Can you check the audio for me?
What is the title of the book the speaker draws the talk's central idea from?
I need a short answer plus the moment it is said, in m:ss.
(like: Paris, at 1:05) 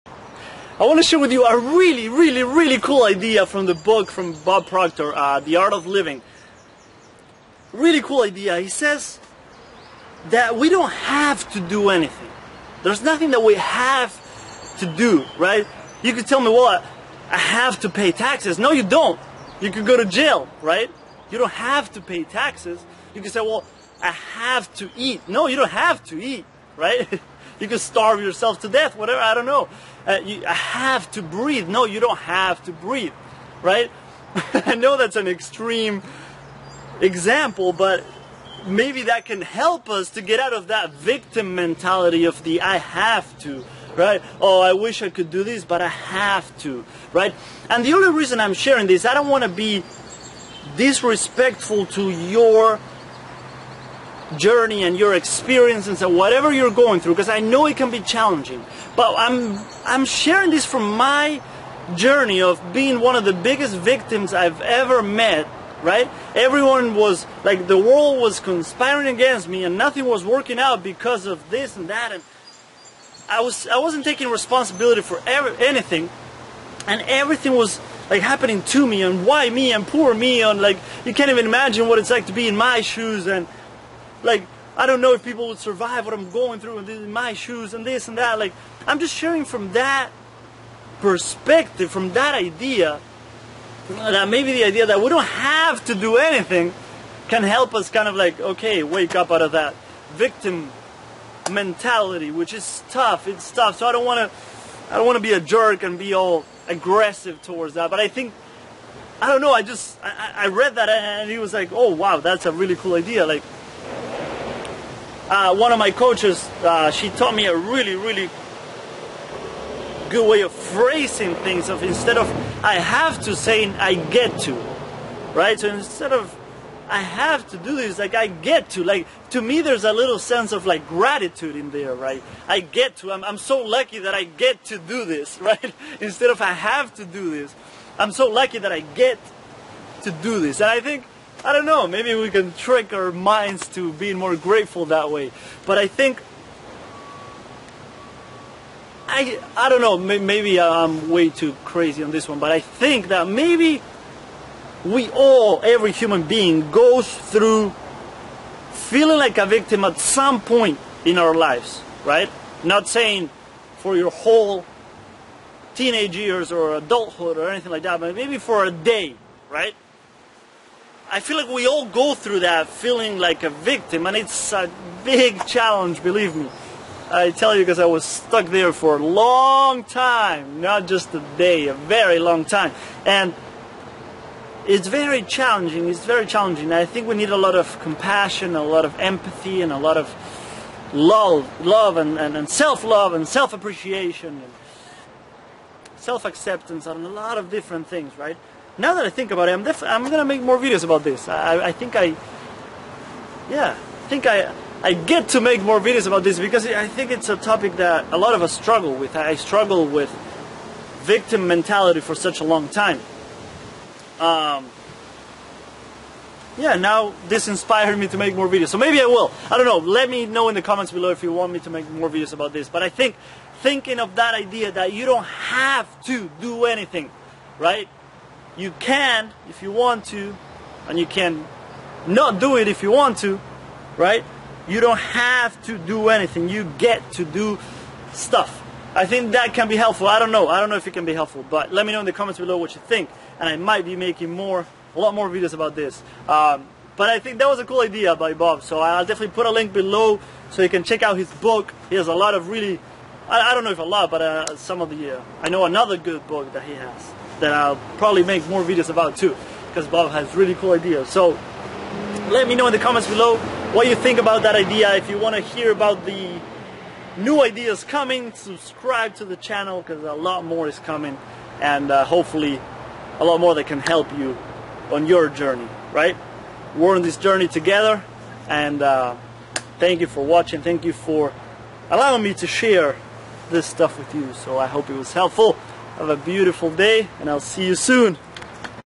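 The Art of Living, at 0:05.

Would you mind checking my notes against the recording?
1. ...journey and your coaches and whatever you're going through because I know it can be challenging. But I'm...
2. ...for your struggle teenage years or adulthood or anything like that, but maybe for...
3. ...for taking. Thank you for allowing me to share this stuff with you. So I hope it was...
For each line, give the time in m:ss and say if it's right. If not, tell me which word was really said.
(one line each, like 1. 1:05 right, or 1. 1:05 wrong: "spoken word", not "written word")
1. 0:54 wrong: "experiences", not "coaches"
2. 2:43 wrong: "whole", not "struggle"
3. 4:40 wrong: "watching", not "taking".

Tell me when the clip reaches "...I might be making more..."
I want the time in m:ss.
4:03.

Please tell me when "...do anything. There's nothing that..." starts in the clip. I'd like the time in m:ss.
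0:11.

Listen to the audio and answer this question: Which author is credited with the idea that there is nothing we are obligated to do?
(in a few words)
Bob Proctor.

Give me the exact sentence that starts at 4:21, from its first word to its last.
So let me know in the comments below what you think about that idea.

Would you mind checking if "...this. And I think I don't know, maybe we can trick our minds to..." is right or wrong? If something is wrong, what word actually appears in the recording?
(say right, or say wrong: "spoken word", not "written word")
right.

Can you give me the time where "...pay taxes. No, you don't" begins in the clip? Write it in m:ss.
0:17.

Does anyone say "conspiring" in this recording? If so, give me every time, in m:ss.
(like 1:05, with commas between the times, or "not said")
1:08.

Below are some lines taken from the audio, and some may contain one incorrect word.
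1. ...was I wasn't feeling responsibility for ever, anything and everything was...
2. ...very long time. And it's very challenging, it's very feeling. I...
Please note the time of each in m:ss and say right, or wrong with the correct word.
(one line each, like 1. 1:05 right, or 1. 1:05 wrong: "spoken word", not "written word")
1. 1:13 wrong: "taking", not "feeling"
2. 3:01 wrong: "challenging", not "feeling".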